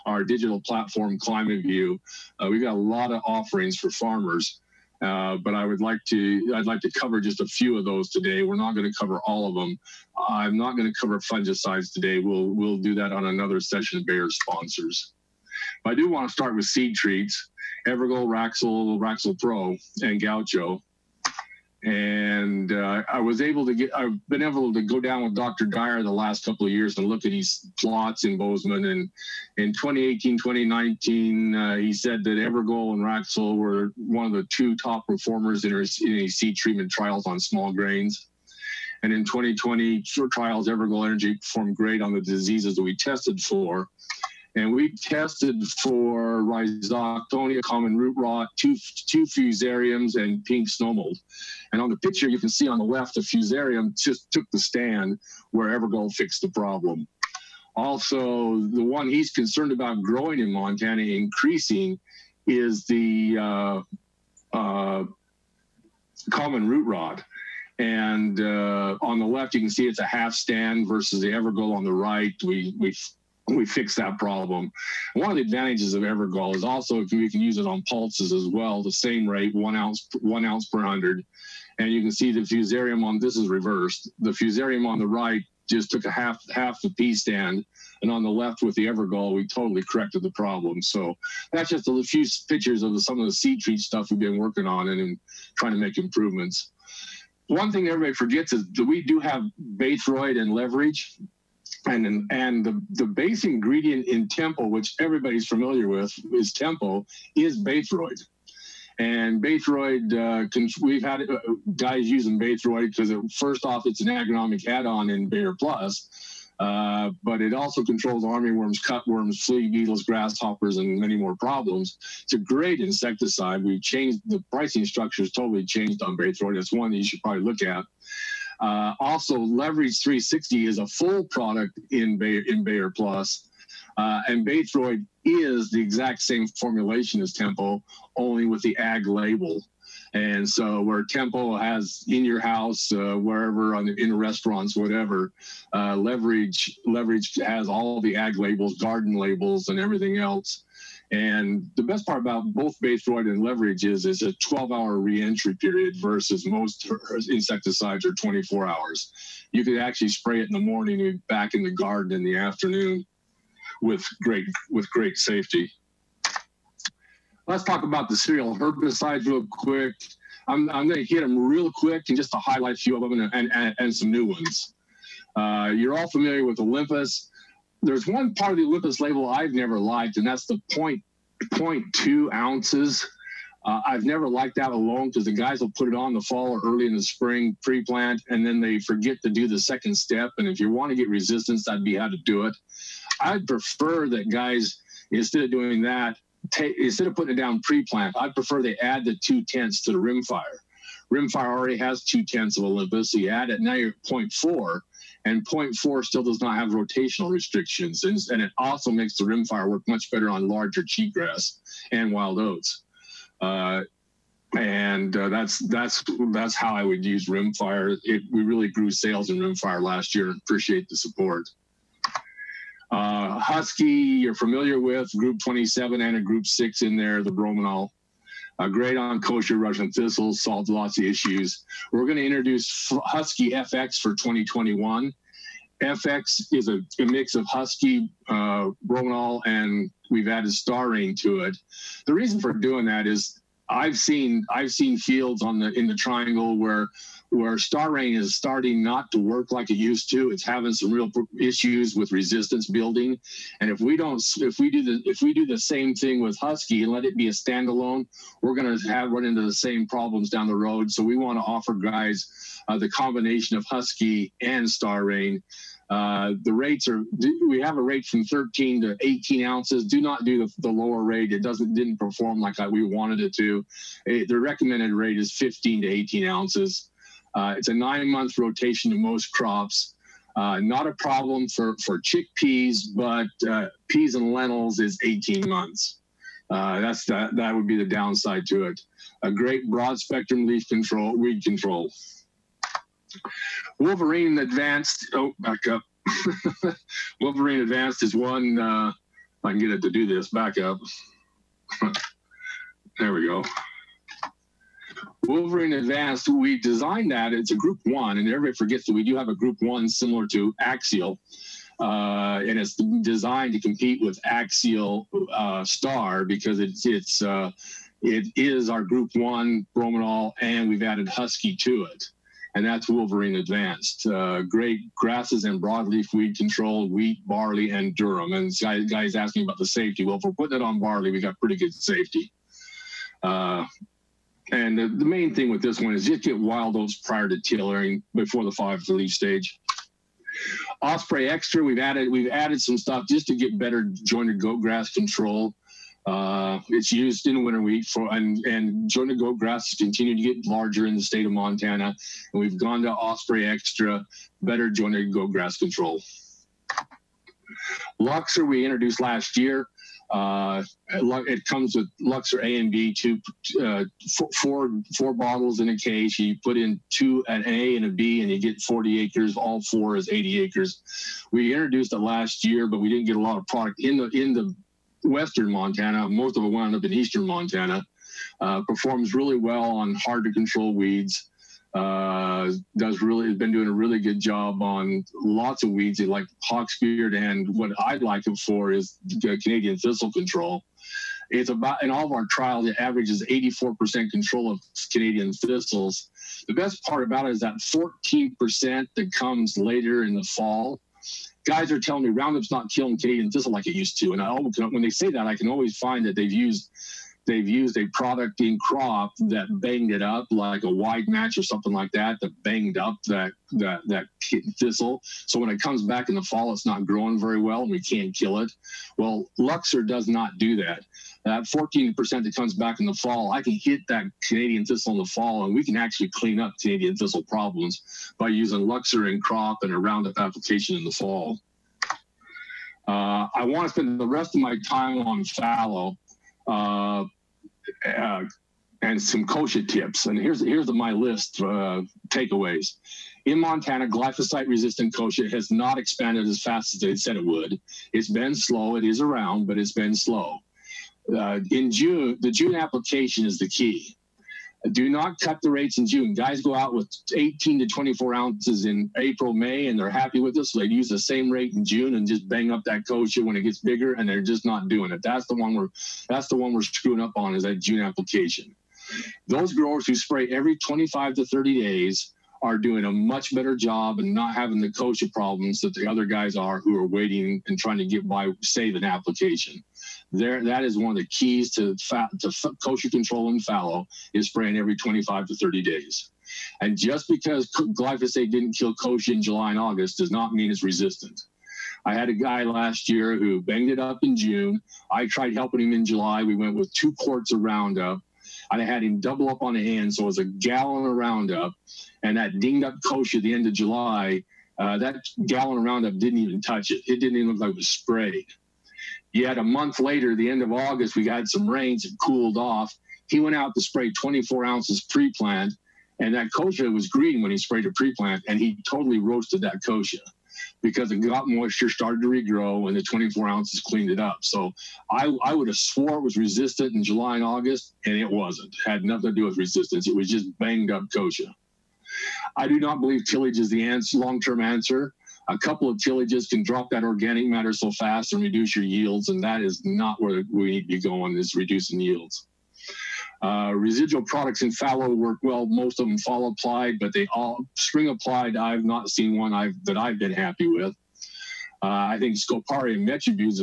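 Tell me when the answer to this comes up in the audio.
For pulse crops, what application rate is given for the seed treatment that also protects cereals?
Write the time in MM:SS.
01:20.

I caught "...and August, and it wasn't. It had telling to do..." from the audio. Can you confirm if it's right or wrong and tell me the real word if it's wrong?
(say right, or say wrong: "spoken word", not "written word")
wrong: "nothing", not "telling".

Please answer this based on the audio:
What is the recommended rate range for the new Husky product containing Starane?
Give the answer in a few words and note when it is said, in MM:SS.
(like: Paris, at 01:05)
15 to 18 ounces, at 04:35.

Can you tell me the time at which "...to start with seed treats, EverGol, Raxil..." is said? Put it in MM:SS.
00:16.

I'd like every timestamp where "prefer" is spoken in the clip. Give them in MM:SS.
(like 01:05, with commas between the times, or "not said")
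03:13, 03:18.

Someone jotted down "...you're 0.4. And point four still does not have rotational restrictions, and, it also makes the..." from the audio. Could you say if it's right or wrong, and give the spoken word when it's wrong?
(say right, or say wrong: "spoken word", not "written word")
right.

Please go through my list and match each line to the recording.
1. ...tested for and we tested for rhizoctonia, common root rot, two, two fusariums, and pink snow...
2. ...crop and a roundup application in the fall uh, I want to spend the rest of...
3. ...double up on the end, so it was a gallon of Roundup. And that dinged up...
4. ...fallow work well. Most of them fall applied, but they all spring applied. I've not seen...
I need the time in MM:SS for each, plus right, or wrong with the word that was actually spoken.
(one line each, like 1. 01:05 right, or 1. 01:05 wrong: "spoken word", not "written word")
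1. 00:42 right
2. 07:09 right
3. 08:18 right
4. 09:04 right.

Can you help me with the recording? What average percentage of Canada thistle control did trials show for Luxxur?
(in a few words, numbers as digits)
84%.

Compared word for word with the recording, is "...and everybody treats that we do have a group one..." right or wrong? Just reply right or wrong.
wrong.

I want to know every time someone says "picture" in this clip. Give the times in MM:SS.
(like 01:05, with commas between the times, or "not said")
00:51, 01:32.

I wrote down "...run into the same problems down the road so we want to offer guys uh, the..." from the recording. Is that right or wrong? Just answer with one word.
right.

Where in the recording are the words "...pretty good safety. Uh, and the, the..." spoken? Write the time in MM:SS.
05:31.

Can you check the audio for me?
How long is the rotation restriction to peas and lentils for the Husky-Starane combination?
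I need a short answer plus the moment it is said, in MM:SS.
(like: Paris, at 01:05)
18 months, at 04:45.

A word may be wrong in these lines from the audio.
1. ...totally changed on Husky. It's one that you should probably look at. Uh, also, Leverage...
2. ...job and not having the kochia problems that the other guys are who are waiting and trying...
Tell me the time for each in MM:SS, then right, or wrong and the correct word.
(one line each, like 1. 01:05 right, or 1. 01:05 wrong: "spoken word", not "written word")
1. 02:05 wrong: "Baythroid", not "Husky"
2. 07:53 right.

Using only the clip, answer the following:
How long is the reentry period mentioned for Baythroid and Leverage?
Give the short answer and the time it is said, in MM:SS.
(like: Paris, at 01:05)
12 hours, at 02:34.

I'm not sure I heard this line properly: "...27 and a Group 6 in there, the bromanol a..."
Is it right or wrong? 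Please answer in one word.
right.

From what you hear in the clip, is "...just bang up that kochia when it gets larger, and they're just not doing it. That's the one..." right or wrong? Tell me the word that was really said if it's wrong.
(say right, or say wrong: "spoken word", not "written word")
wrong: "bigger", not "larger".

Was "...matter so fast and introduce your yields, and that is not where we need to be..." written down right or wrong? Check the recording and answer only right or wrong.
wrong.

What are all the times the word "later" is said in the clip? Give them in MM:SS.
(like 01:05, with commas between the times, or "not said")
06:39, 08:29.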